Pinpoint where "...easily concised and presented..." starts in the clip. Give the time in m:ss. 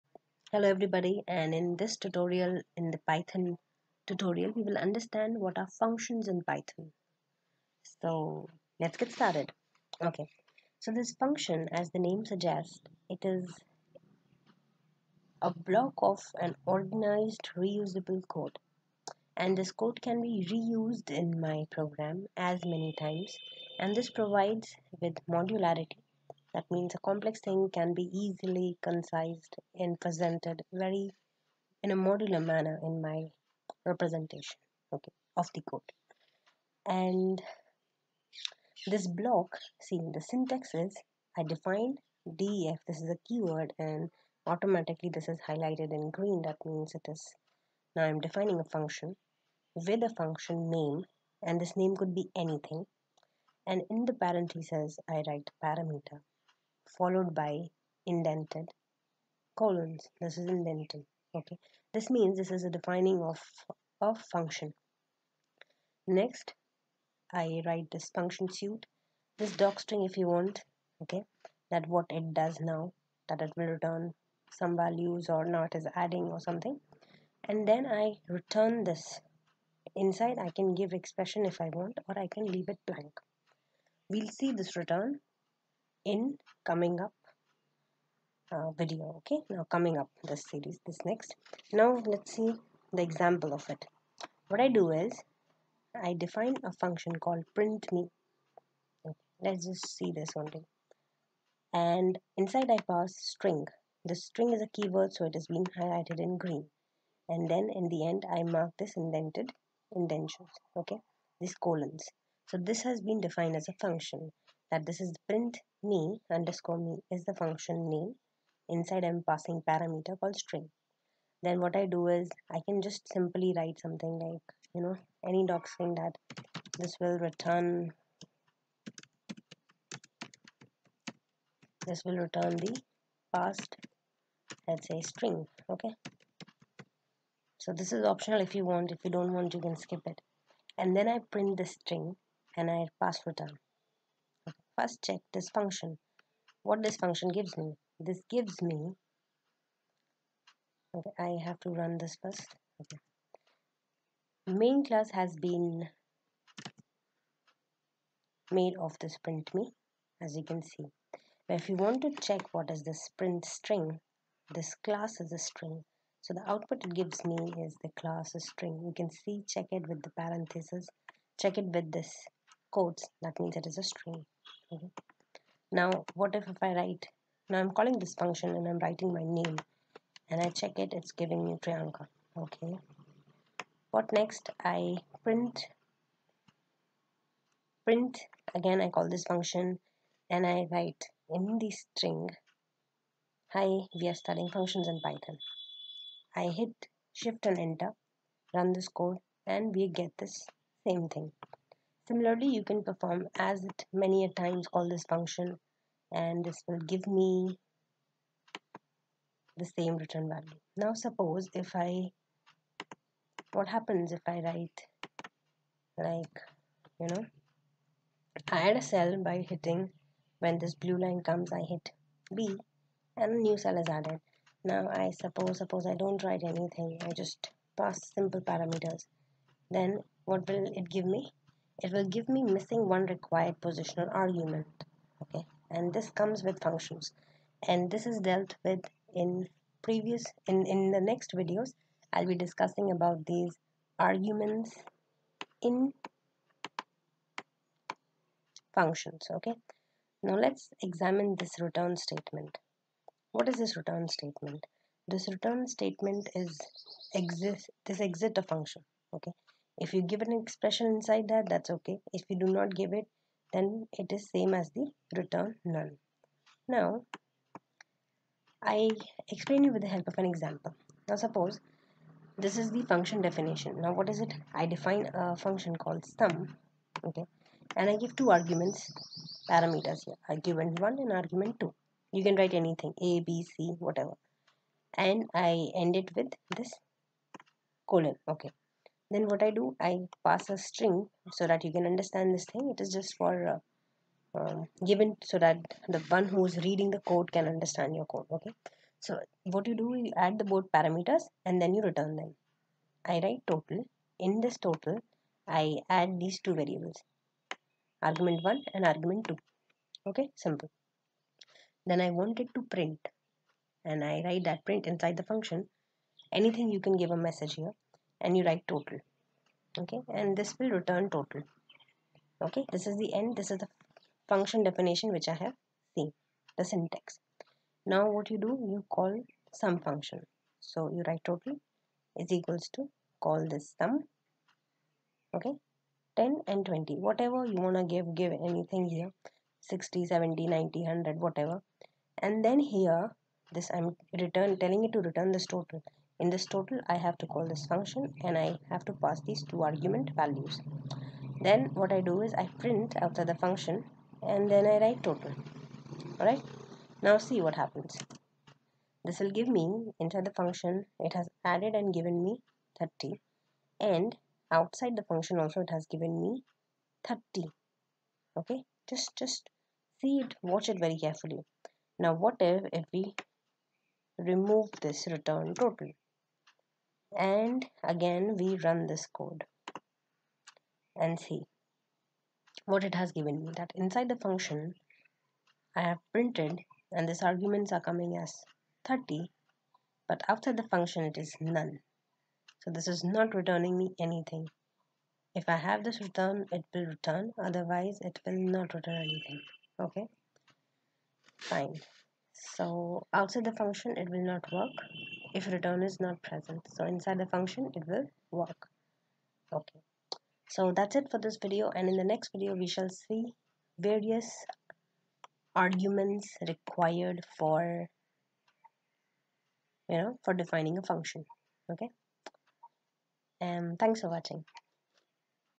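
0:28.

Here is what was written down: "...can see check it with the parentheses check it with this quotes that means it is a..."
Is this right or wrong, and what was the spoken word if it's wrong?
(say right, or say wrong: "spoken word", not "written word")
right.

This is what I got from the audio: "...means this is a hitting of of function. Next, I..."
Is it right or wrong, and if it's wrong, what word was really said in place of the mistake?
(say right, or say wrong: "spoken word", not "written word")
wrong: "defining", not "hitting".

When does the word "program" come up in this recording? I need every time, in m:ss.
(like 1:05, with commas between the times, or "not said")
0:21.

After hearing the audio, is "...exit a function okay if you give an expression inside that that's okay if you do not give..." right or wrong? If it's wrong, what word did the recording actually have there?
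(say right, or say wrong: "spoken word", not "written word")
right.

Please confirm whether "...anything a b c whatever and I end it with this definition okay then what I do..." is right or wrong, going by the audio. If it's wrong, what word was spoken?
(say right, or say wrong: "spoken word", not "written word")
wrong: "colon", not "definition".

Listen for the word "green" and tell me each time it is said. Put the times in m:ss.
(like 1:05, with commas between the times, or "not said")
0:46, 1:46.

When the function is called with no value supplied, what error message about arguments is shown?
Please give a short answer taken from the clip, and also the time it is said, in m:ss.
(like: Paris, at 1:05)
missing one required positional argument, at 3:52.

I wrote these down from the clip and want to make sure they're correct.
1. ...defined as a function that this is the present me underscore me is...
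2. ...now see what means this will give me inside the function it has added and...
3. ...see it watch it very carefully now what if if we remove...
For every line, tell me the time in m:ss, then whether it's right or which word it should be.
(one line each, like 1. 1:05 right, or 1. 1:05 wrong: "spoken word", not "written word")
1. 1:53 wrong: "print", not "present"
2. 5:57 wrong: "happens", not "means"
3. 6:09 right.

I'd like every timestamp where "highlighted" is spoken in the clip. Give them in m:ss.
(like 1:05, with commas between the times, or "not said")
0:45, 1:45.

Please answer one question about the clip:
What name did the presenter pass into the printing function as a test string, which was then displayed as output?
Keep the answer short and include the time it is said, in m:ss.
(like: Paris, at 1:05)
Priyanka, at 3:01.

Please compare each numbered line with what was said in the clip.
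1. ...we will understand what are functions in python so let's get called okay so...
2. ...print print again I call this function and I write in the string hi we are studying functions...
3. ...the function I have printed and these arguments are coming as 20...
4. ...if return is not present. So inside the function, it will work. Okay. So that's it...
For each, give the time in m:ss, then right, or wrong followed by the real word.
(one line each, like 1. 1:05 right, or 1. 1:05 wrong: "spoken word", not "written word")
1. 0:04 wrong: "started", not "called"
2. 3:05 right
3. 6:24 wrong: "30", not "20"
4. 6:45 right.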